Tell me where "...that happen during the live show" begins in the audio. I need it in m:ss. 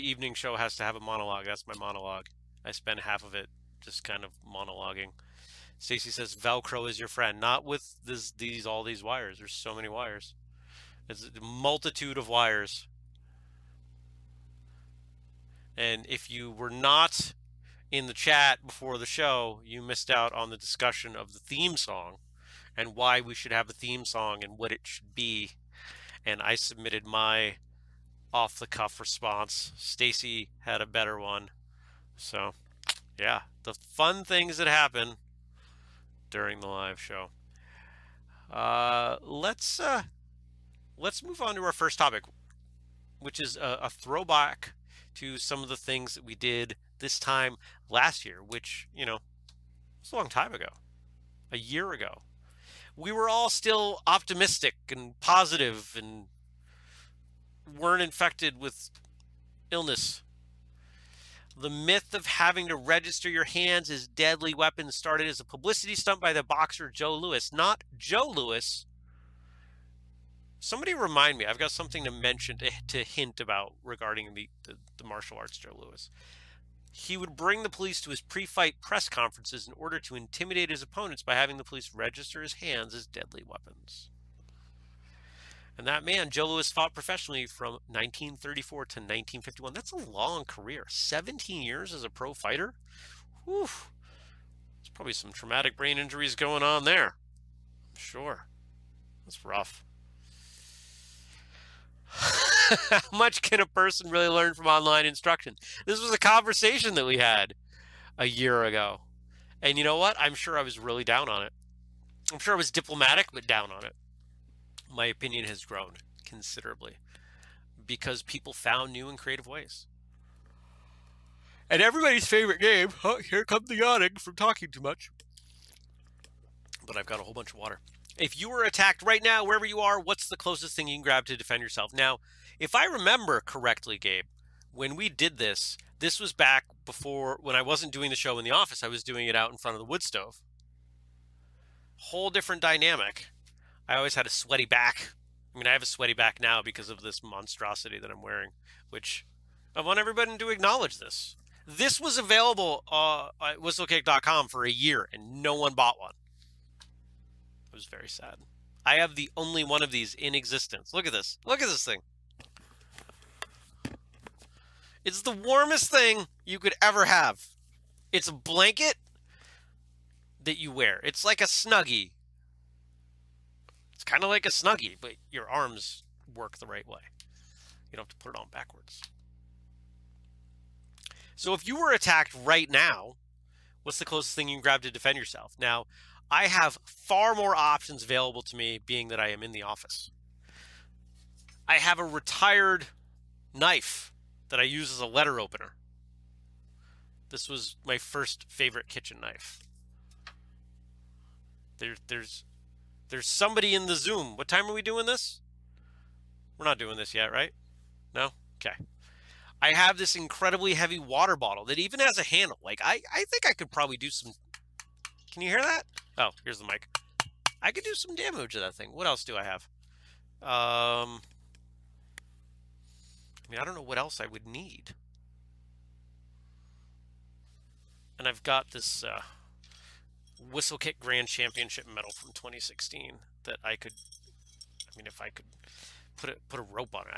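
0:34.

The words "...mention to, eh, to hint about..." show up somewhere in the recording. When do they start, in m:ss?
1:12.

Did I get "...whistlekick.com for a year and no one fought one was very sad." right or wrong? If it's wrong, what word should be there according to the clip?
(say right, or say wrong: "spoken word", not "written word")
wrong: "bought", not "fought".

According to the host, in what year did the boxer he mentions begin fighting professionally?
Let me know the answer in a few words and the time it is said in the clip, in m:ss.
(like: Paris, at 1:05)
1934, at 1:27.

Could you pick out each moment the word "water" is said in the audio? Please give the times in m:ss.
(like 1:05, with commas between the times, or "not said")
2:07, 3:30.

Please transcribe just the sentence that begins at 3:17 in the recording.
This was my first favorite kitchen knife.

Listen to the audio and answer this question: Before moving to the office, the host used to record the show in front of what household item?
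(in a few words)
wood stove.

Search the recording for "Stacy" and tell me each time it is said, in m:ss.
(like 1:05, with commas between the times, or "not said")
0:05, 0:29.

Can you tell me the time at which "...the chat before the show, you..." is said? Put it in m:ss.
0:18.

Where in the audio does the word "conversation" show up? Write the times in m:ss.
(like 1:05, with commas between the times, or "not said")
1:46.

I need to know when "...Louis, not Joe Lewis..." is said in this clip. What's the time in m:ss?
1:07.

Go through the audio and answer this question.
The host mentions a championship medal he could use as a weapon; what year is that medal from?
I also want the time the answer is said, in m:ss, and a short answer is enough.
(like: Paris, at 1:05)
2016, at 3:52.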